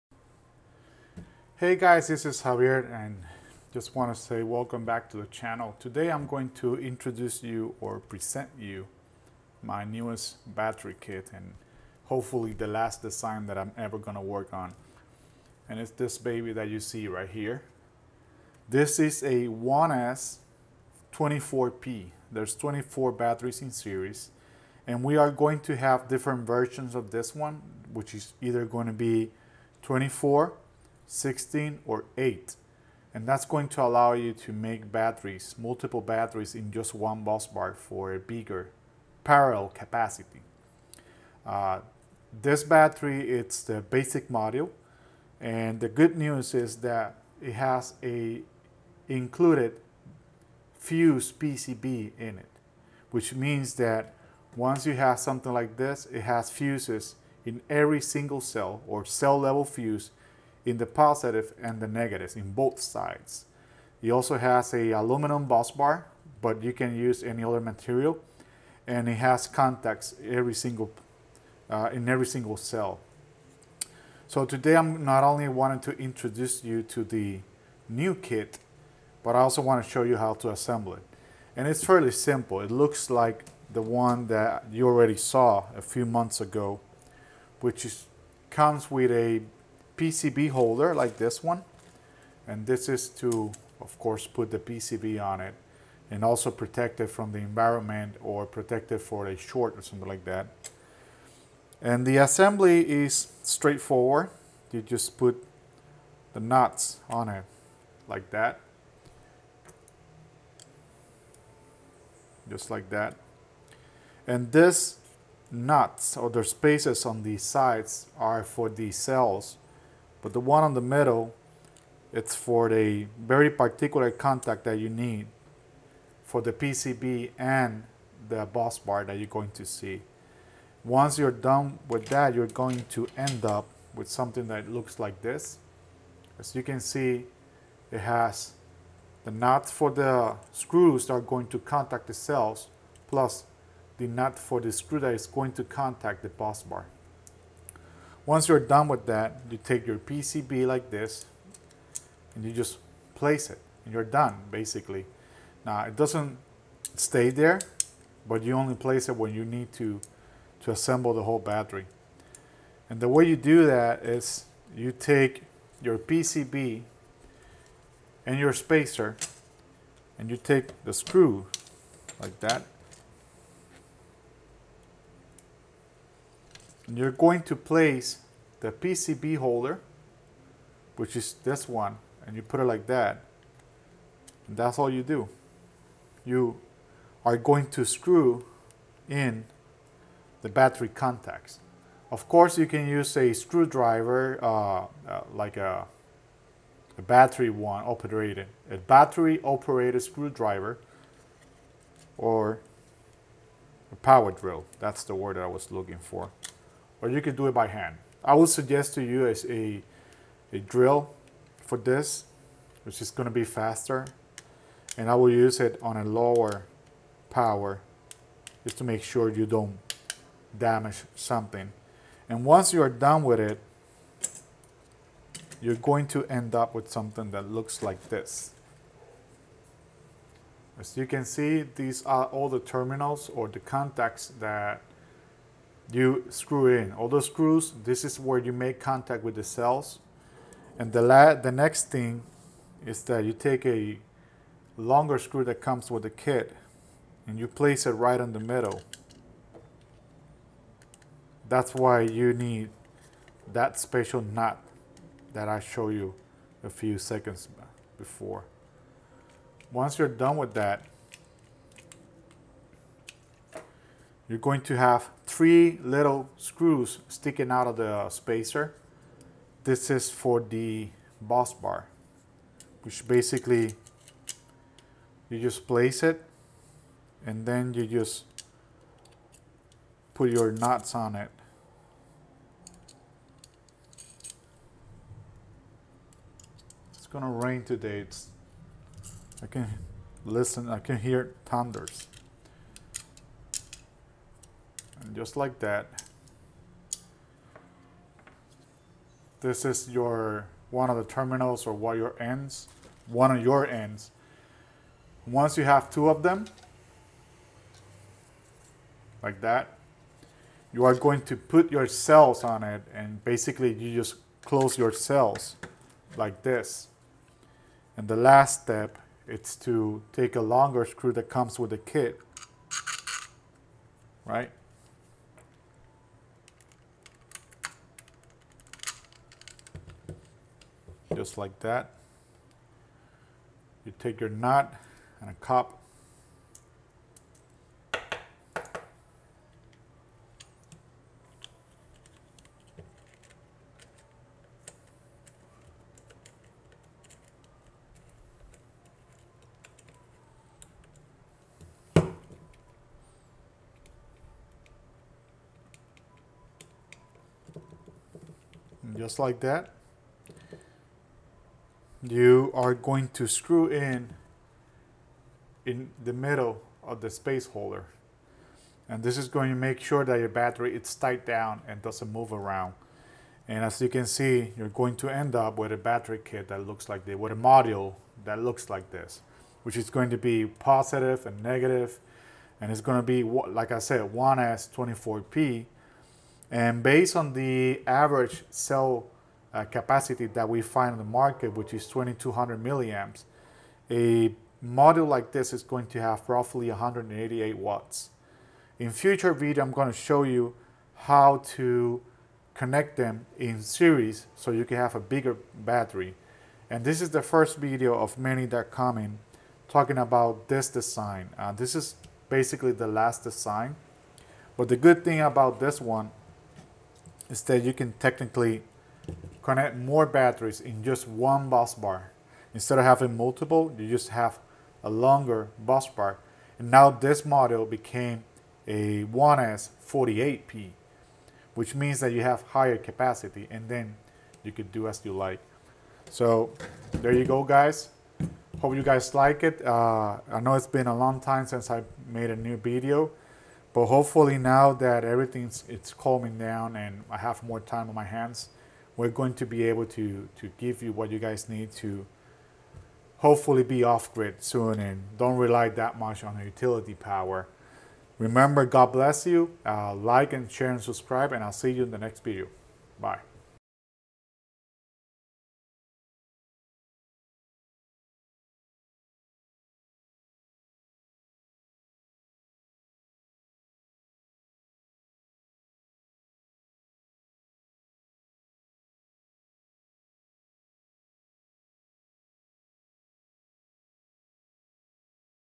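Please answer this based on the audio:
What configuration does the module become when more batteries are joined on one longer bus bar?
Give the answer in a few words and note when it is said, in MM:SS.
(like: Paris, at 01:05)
1S48P, at 07:09.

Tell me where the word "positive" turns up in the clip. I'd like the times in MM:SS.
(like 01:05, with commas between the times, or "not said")
01:00, 06:20.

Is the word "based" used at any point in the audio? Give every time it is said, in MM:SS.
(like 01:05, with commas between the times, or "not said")
06:26.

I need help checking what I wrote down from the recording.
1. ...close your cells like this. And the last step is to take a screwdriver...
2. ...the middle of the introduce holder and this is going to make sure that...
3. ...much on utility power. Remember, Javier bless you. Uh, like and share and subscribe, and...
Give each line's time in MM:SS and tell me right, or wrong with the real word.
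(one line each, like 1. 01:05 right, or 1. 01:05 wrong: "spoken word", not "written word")
1. 05:14 wrong: "longer", not "screwdriver"
2. 06:06 wrong: "space", not "introduce"
3. 07:35 wrong: "God", not "Javier".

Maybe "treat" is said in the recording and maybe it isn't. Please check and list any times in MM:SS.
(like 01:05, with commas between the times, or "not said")
not said.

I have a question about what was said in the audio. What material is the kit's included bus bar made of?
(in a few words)
Aluminum.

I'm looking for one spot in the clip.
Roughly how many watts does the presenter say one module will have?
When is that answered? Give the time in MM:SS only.
06:36.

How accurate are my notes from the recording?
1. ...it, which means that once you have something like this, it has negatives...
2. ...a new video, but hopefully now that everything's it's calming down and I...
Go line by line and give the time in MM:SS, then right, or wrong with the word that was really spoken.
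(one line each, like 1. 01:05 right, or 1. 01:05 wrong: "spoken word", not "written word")
1. 00:52 wrong: "fuses", not "negatives"
2. 07:22 right.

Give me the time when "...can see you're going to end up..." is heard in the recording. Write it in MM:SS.
06:13.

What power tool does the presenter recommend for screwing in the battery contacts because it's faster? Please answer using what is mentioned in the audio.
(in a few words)
Power drill.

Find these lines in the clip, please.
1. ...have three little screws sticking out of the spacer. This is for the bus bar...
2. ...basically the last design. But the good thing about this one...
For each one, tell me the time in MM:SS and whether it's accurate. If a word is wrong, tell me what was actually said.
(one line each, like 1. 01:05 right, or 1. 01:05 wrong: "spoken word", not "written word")
1. 04:24 right
2. 06:52 right.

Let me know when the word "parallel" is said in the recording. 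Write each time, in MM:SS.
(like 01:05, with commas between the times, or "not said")
00:39.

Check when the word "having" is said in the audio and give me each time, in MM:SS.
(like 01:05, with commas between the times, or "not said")
07:02.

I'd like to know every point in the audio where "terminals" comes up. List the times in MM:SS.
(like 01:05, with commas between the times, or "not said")
03:52, 05:01.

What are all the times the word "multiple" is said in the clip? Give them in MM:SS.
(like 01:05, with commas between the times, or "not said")
00:35, 07:03.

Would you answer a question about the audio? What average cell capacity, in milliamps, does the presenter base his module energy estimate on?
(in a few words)
2200 milliamps.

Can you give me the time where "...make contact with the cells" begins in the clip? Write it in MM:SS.
03:58.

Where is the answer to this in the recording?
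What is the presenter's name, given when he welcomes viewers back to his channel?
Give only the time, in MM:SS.
00:02.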